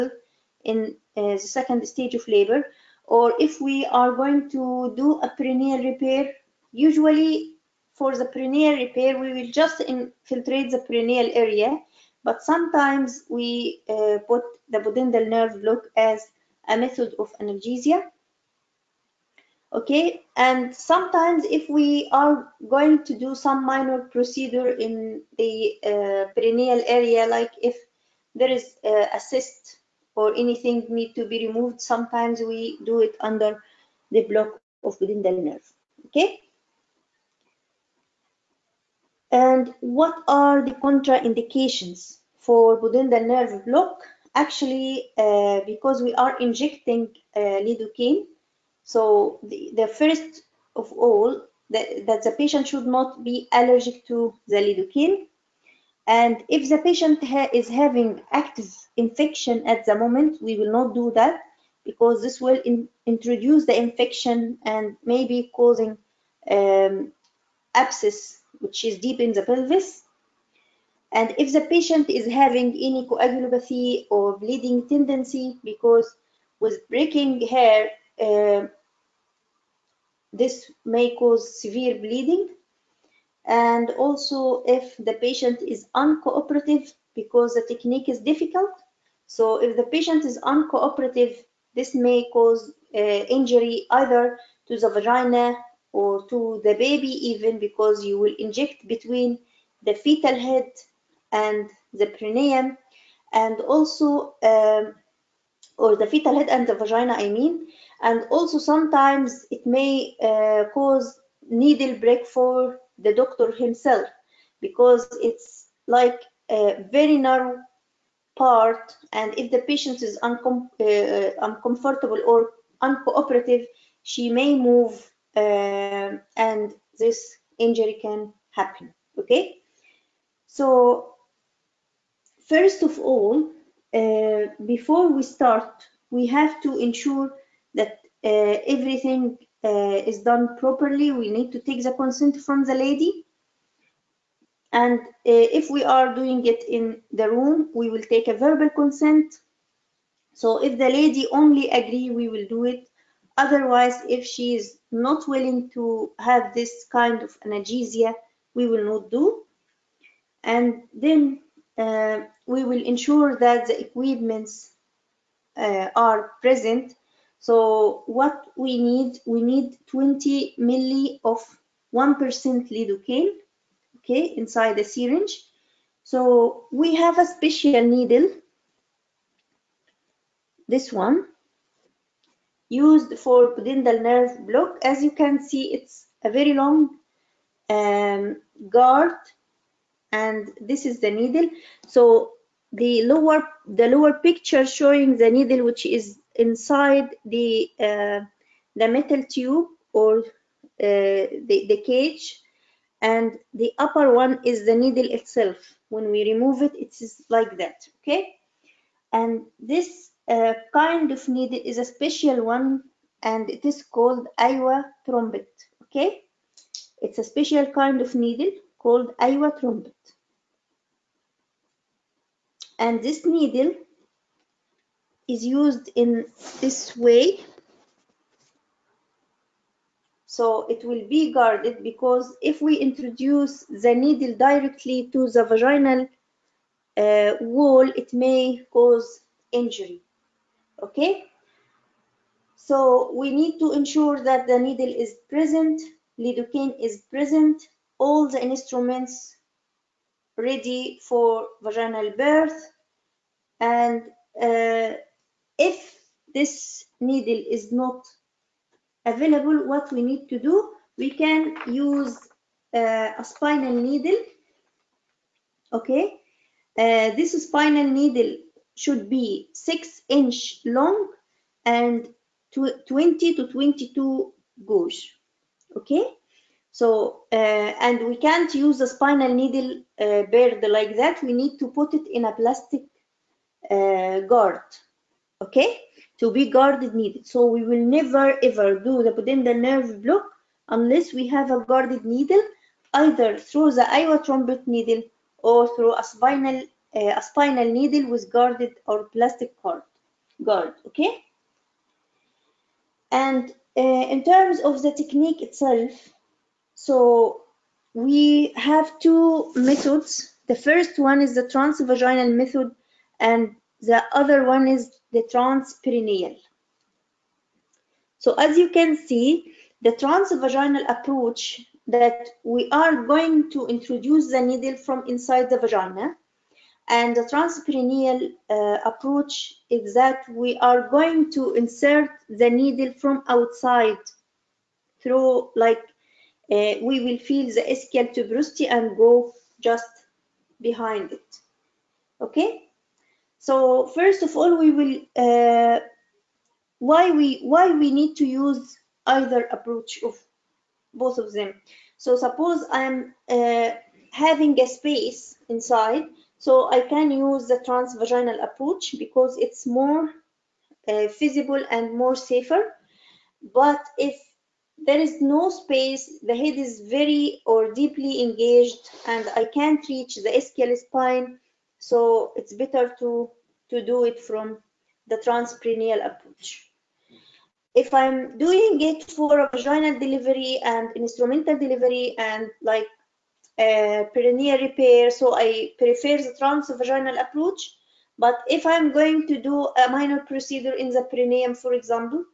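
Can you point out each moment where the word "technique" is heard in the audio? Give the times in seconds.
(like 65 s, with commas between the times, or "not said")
87 s, 304 s.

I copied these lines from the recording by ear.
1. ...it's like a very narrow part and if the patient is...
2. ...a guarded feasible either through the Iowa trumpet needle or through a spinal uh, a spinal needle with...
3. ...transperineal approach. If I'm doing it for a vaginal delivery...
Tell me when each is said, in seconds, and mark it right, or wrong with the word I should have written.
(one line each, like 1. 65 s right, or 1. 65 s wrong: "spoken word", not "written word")
1. 115 s right
2. 291 s wrong: "needle", not "feasible"
3. 375 s right.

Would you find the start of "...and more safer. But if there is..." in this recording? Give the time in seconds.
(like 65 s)
361 s.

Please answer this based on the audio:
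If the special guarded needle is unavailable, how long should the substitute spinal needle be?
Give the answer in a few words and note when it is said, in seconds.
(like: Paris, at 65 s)
6 inches, at 269 s.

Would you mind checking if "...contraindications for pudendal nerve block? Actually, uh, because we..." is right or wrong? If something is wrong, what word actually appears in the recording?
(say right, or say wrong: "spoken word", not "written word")
right.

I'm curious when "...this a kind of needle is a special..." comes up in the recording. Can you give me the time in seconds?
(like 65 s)
209 s.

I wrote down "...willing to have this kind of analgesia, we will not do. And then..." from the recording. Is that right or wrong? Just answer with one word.
right.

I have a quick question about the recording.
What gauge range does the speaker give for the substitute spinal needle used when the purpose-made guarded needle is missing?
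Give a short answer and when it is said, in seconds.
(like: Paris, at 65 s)
20 to 22 gauge, at 272 s.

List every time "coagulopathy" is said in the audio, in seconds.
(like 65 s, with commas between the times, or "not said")
73 s.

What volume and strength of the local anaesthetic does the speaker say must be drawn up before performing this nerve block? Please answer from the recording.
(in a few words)
20 ml of 1% lidocaine.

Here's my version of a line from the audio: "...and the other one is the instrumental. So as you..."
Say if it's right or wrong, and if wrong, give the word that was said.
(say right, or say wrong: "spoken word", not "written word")
wrong: "transperineal", not "instrumental".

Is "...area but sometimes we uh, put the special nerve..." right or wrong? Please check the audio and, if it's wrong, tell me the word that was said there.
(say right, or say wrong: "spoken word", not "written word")
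wrong: "pudendal", not "special".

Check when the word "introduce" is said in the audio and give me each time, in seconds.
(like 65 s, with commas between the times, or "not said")
63 s, 232 s, 323 s.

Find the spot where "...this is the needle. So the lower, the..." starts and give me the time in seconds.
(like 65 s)
190 s.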